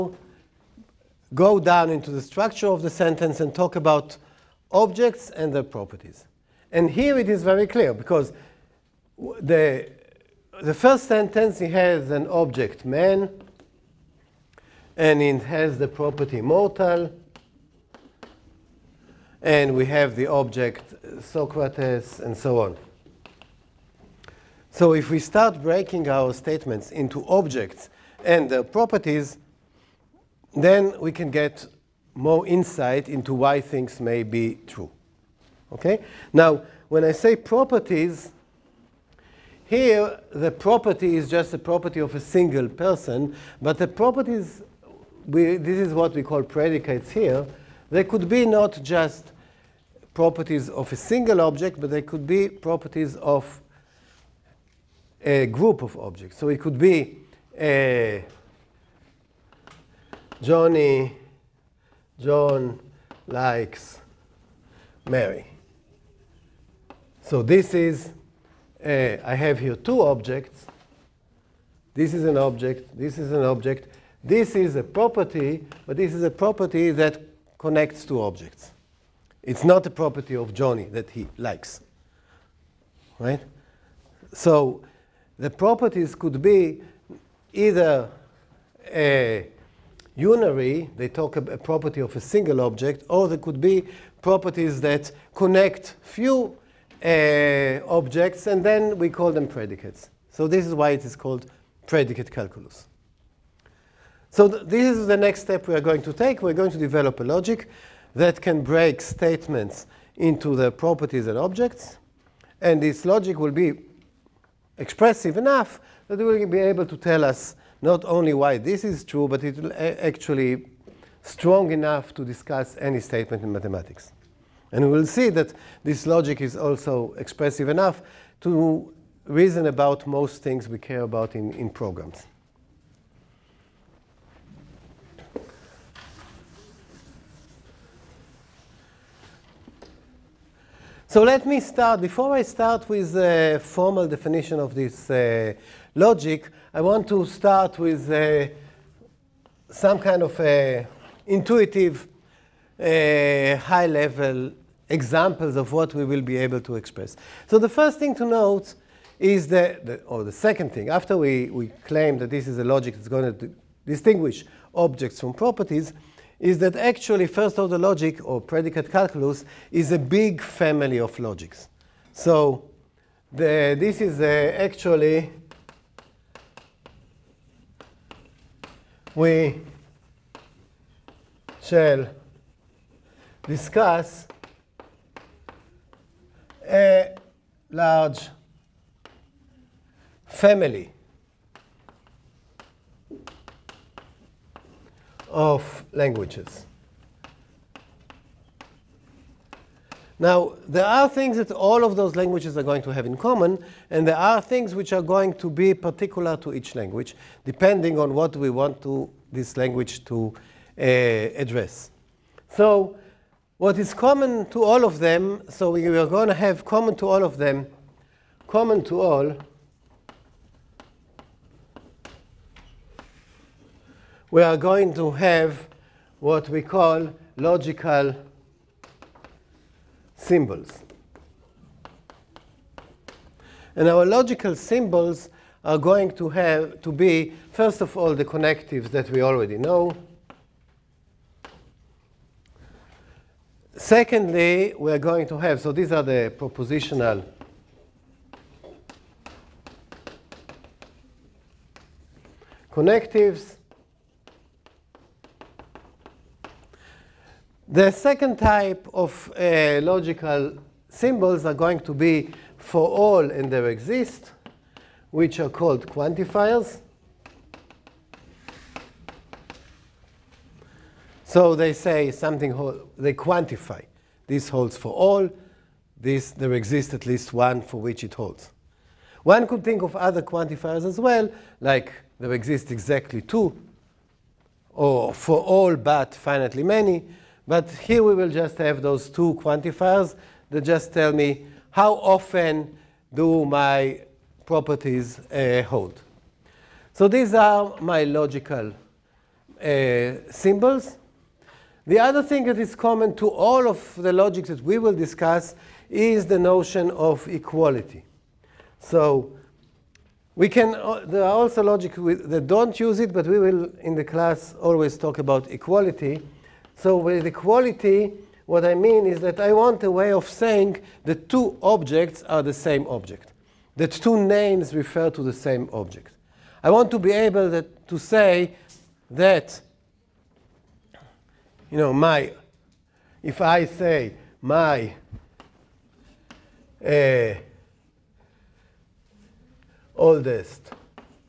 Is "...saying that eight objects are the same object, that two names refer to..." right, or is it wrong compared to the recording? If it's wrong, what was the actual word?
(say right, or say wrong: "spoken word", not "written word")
wrong: "two", not "eight".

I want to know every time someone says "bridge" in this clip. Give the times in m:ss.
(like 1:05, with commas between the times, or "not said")
not said.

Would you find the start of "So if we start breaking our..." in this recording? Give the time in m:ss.
0:24.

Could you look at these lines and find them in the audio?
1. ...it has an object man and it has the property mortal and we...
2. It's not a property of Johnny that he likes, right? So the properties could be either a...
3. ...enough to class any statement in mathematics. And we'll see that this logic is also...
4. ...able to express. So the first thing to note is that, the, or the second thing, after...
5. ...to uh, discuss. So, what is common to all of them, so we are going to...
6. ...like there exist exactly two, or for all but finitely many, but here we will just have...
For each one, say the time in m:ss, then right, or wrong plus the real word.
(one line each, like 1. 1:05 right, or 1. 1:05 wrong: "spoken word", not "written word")
1. 0:11 right
2. 1:19 right
3. 2:01 wrong: "discuss", not "class"
4. 2:36 right
5. 3:30 wrong: "address", not "discuss"
6. 4:41 right.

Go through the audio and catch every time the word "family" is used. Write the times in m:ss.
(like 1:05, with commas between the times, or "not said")
2:50, 3:10.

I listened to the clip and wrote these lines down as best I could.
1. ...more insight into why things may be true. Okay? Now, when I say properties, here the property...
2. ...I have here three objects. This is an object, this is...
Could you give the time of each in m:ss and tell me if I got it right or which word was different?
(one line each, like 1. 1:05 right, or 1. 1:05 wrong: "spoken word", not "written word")
1. 0:32 right
2. 1:08 wrong: "two", not "three".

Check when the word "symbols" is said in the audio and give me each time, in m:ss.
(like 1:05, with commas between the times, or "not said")
3:50, 3:54, 4:20, 5:00.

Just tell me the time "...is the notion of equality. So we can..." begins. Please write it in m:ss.
5:05.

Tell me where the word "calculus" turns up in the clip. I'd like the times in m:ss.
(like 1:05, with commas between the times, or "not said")
1:42, 2:48.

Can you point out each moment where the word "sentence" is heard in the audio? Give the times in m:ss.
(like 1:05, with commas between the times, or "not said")
0:02, 0:11.